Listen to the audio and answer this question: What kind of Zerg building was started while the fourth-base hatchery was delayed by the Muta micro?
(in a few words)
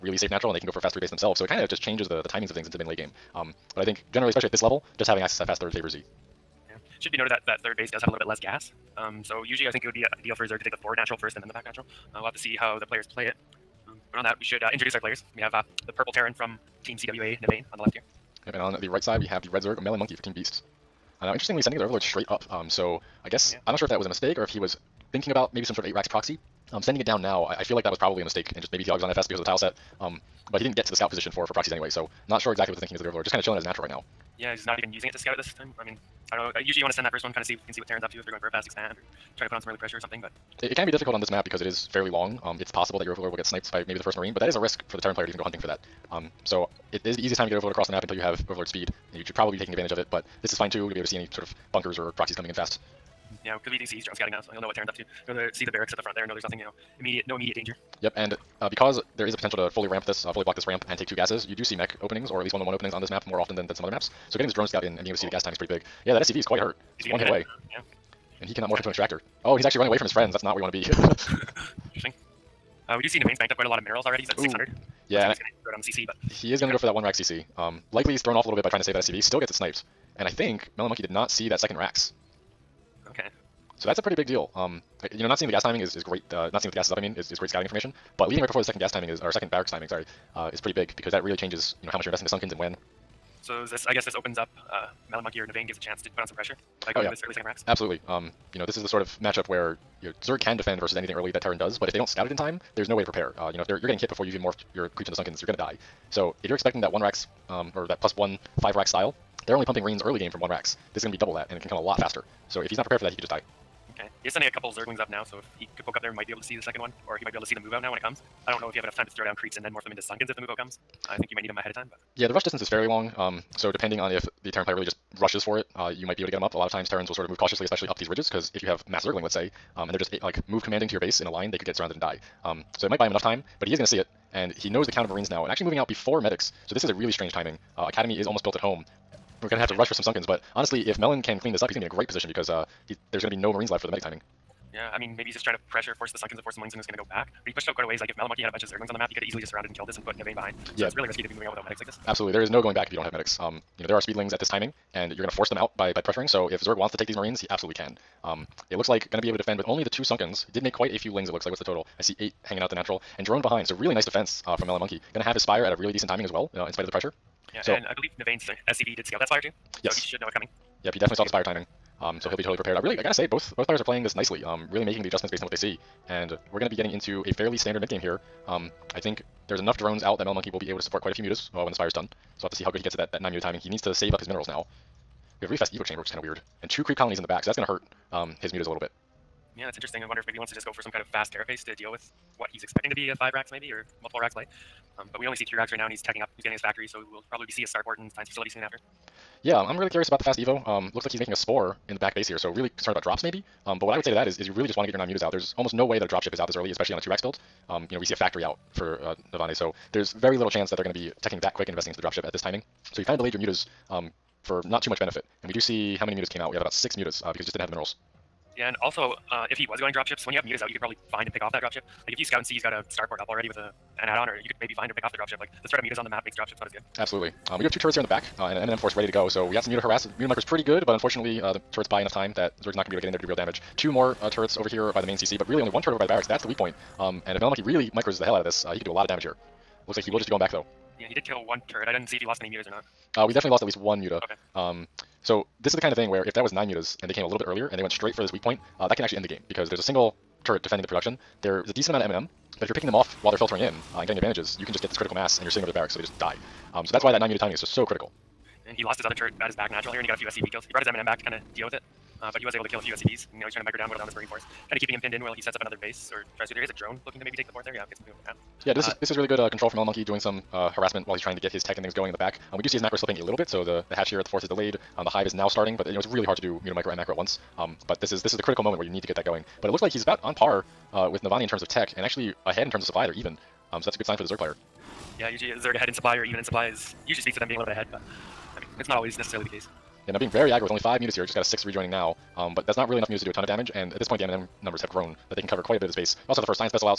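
hive.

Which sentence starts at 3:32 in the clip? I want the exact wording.
So you've kind of delayed your mutas um, for not too much benefit.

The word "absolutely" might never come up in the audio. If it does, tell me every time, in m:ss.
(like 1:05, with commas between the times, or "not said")
1:37, 2:32, 2:37, 3:46.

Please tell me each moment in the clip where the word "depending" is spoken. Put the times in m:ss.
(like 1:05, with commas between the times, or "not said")
2:03.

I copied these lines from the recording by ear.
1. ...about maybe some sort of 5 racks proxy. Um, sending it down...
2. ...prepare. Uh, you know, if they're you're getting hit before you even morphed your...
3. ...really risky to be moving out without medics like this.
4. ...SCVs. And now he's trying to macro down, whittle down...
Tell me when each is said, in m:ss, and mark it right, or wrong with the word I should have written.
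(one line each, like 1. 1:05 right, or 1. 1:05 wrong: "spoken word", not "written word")
1. 0:25 wrong: "8", not "5"
2. 1:43 right
3. 2:30 right
4. 4:22 wrong: "micro", not "macro".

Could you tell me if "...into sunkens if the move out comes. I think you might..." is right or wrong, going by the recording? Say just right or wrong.
right.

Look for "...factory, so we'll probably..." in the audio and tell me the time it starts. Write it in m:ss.
3:16.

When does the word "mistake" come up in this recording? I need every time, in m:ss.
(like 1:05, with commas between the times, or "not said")
0:24, 0:28.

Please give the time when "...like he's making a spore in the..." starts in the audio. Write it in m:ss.
3:21.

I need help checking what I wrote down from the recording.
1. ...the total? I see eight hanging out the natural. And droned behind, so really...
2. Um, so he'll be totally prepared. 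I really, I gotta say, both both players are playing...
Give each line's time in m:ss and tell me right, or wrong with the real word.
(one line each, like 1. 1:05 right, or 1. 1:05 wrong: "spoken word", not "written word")
1. 2:41 right
2. 2:52 right.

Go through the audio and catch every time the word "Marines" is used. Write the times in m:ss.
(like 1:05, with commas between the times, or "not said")
0:44, 2:15, 2:23, 2:37, 4:24.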